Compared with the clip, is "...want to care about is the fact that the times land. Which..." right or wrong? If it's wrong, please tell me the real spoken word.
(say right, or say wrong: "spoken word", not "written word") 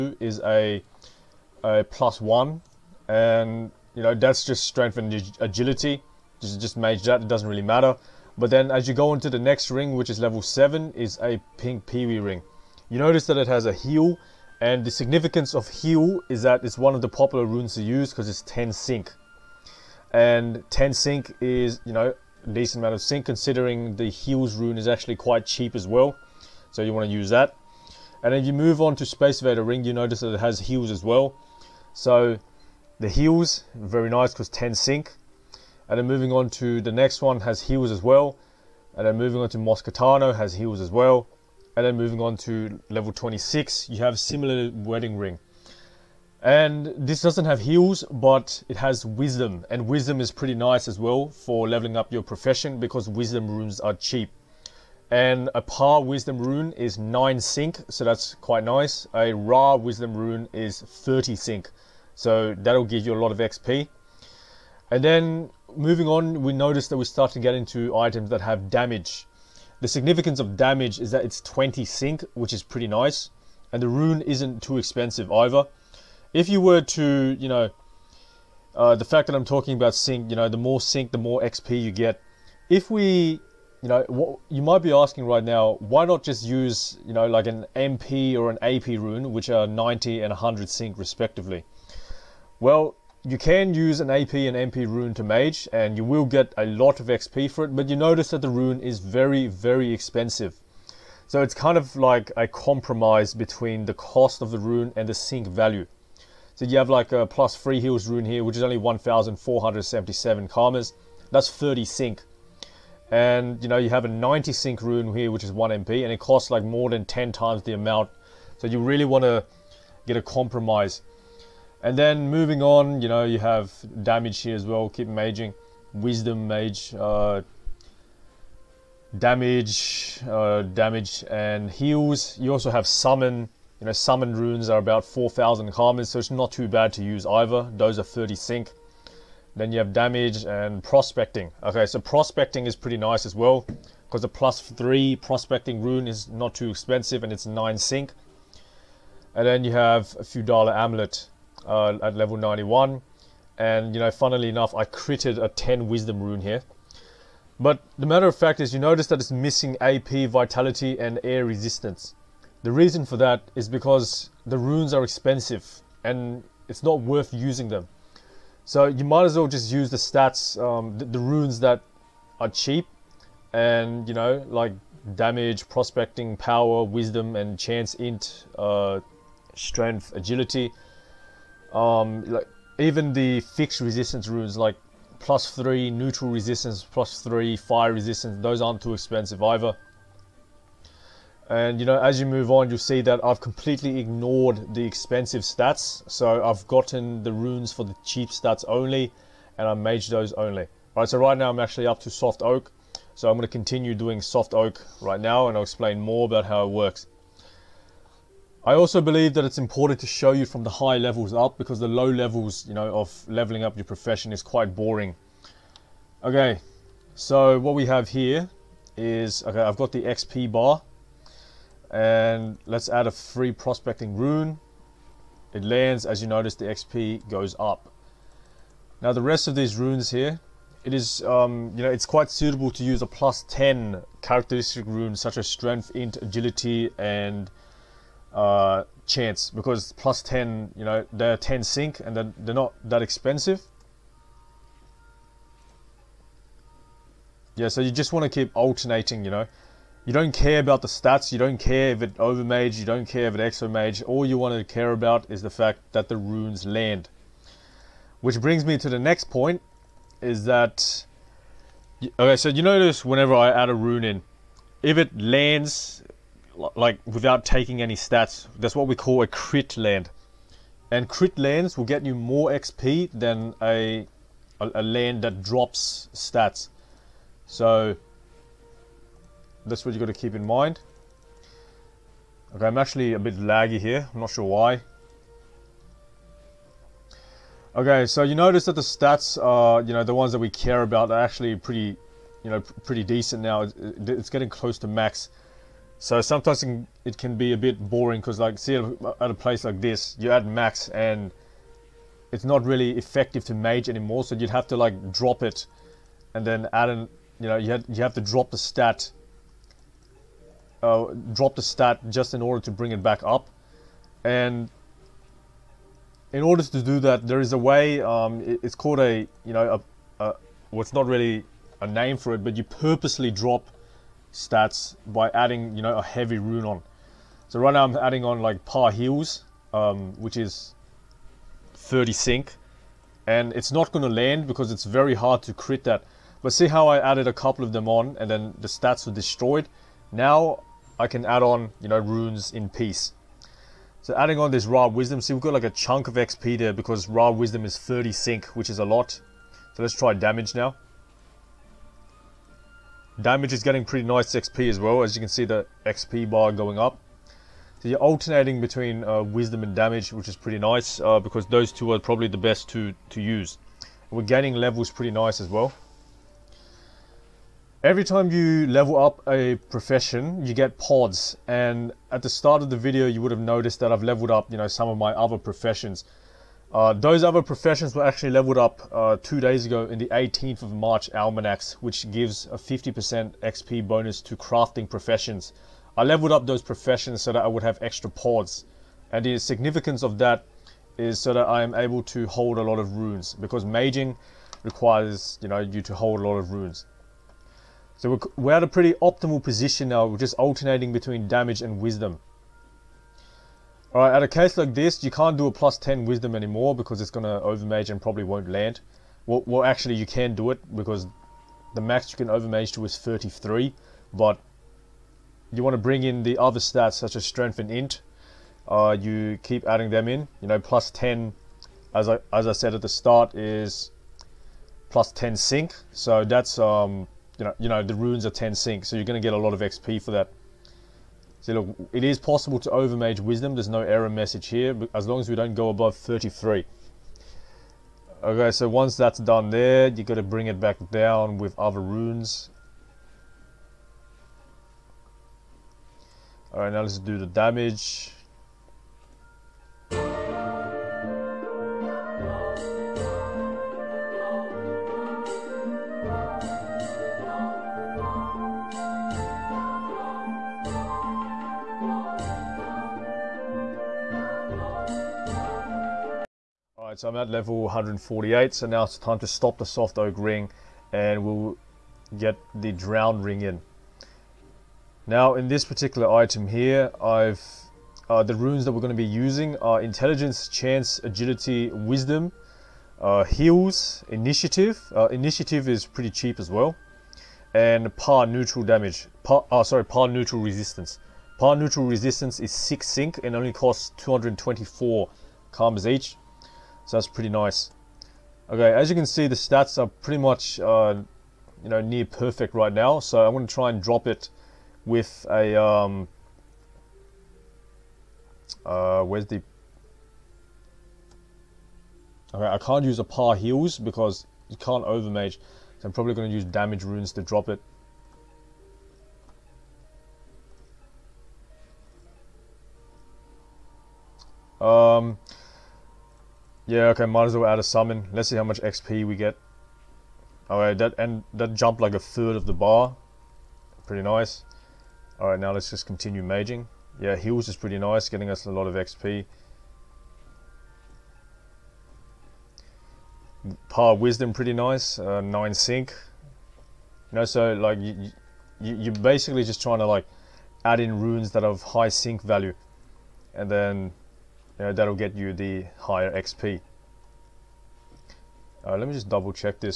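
wrong: "runes", not "times".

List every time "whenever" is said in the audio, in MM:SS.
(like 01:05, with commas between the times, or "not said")
04:23.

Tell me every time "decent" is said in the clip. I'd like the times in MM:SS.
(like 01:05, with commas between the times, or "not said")
00:22, 04:53.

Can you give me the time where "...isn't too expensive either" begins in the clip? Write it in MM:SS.
01:14.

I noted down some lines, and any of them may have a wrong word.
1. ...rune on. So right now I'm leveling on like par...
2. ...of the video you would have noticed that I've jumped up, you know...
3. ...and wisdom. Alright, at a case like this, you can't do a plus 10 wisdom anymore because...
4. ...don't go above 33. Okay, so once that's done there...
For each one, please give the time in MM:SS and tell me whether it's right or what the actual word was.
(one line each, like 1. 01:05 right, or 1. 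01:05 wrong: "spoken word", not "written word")
1. 05:26 wrong: "adding", not "leveling"
2. 06:12 wrong: "leveled", not "jumped"
3. 06:41 right
4. 07:15 right.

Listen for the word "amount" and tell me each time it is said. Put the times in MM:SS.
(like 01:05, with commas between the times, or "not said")
00:22, 01:57.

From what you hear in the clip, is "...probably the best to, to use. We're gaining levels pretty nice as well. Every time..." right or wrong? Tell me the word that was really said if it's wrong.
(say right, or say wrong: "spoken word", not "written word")
right.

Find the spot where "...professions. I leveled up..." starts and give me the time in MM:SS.
06:24.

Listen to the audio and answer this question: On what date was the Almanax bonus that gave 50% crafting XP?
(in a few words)
18th of March.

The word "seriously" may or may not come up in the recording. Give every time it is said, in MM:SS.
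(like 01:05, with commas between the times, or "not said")
not said.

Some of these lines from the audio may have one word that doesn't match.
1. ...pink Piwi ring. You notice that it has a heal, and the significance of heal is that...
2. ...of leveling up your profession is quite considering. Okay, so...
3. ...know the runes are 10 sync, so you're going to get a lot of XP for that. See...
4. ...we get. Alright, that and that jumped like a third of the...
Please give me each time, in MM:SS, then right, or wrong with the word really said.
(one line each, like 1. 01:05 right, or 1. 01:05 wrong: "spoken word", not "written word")
1. 00:11 right
2. 03:32 wrong: "boring", not "considering"
3. 07:07 right
4. 08:49 right.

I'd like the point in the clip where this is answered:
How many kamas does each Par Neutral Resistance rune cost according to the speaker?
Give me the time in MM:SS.
08:13.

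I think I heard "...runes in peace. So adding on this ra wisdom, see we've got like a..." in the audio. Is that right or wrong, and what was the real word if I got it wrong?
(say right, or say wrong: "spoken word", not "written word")
right.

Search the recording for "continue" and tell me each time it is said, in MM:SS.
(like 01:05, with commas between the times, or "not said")
03:23, 08:55.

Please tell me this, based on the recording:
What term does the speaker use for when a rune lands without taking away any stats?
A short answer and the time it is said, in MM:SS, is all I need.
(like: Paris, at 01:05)
crit land, at 04:29.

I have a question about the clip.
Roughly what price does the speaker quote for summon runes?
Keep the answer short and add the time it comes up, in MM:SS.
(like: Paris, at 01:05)
4,000 kamas, at 02:14.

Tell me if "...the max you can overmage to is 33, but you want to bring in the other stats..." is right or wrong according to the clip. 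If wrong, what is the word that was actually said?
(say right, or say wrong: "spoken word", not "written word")
right.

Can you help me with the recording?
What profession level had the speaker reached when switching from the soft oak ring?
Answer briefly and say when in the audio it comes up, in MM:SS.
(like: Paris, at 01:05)
148, at 07:47.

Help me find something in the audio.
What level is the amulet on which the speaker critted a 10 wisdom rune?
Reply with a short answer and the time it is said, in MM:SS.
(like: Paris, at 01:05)
91, at 02:32.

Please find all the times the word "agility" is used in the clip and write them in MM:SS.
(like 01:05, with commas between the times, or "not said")
00:05, 03:00, 03:56, 08:01.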